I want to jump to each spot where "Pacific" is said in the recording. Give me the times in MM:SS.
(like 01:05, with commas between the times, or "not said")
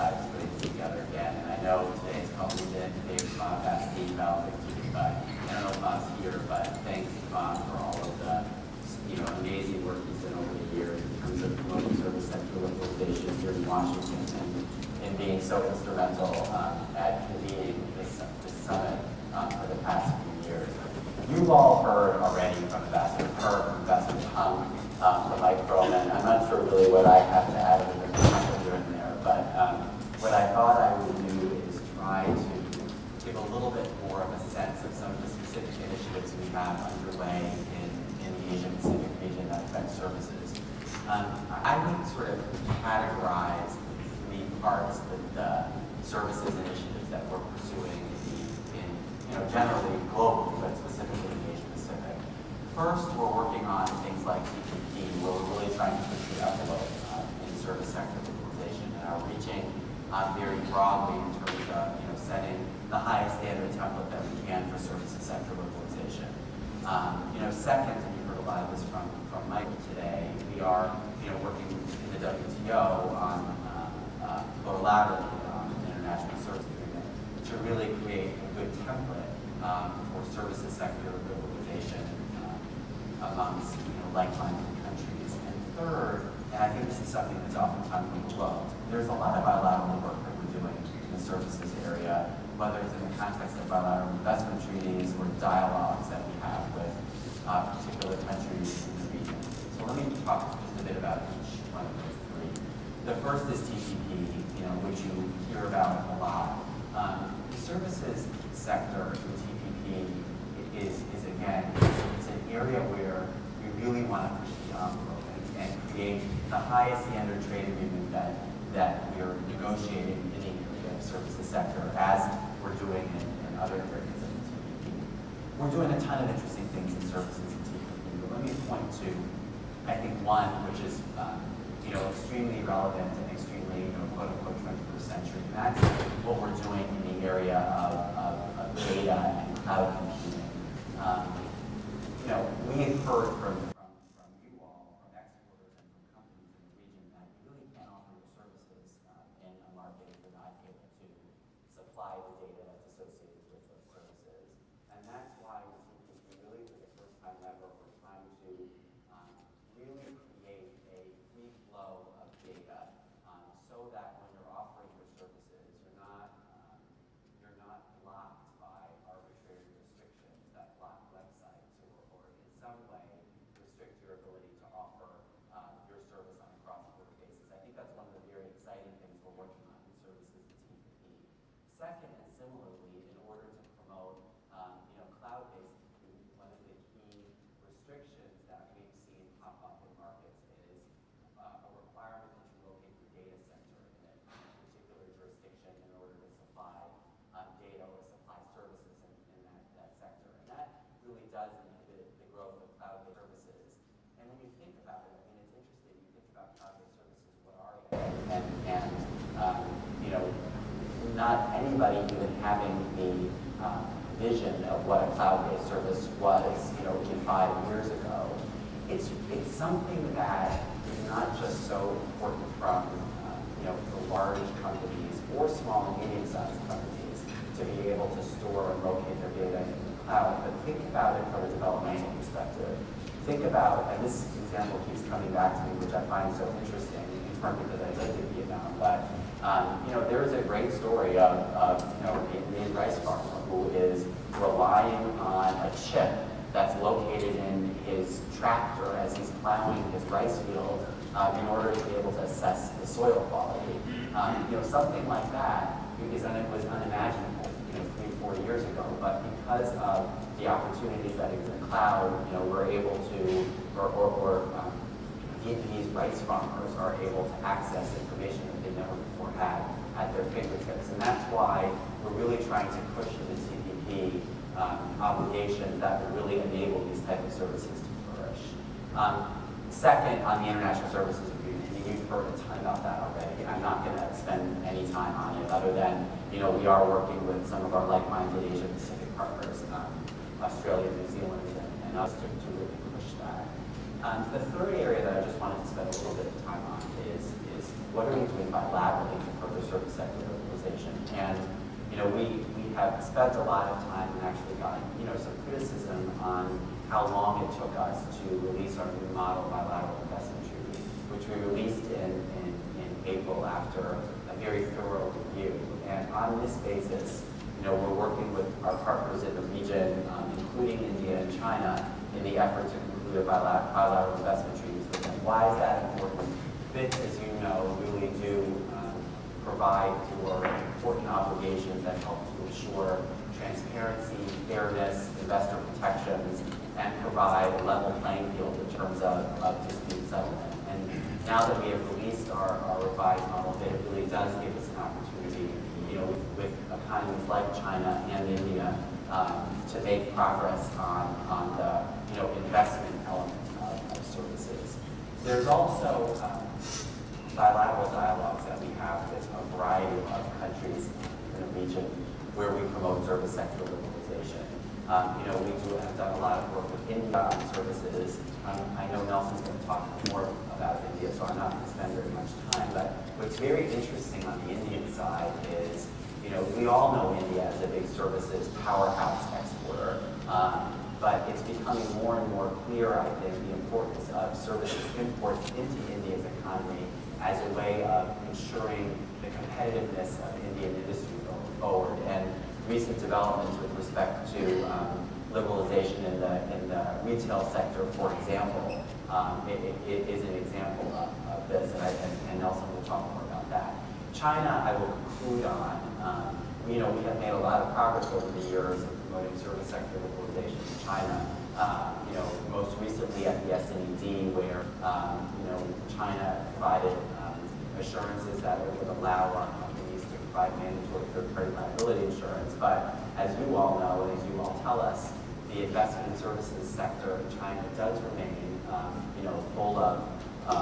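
00:38, 04:48.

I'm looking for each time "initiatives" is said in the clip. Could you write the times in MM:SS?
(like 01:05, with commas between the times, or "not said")
00:35, 00:46.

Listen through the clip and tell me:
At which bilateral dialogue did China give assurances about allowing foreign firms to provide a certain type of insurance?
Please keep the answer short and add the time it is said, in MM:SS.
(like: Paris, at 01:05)
S&ED, at 06:53.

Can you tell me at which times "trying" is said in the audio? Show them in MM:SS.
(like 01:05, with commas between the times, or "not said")
02:37, 04:32.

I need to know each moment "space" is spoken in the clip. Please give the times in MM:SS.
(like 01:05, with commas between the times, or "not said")
not said.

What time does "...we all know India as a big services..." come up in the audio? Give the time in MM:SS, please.
06:16.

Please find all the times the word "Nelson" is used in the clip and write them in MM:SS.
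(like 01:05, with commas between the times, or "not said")
06:09, 06:42.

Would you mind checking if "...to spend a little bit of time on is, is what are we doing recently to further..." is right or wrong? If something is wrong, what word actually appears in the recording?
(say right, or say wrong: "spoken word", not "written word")
wrong: "bilaterally", not "recently".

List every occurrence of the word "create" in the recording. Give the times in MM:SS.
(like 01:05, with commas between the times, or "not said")
01:18, 02:40.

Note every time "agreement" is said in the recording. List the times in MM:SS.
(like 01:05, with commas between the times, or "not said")
01:16, 04:41.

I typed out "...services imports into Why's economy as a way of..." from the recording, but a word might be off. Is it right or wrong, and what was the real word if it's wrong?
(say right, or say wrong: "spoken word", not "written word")
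wrong: "India", not "Why".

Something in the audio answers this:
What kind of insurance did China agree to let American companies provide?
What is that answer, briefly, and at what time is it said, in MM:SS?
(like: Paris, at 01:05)
Mandatory third-party liability insurance, at 07:00.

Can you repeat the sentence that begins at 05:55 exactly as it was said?
There's also um, bilateral dialogues that we have with a variety of countries in the region where we promote service sector liberalization.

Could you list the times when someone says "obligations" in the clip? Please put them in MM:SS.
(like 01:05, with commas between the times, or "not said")
04:34, 05:31.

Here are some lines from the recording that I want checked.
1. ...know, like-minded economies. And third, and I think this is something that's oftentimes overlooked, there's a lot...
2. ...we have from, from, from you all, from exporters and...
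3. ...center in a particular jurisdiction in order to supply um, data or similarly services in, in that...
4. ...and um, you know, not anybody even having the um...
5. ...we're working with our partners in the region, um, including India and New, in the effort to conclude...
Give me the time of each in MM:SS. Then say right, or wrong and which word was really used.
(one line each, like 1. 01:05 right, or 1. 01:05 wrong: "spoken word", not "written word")
1. 01:24 wrong: "countries", not "economies"
2. 02:22 right
3. 03:13 wrong: "supply", not "similarly"
4. 03:28 right
5. 05:17 wrong: "China", not "New".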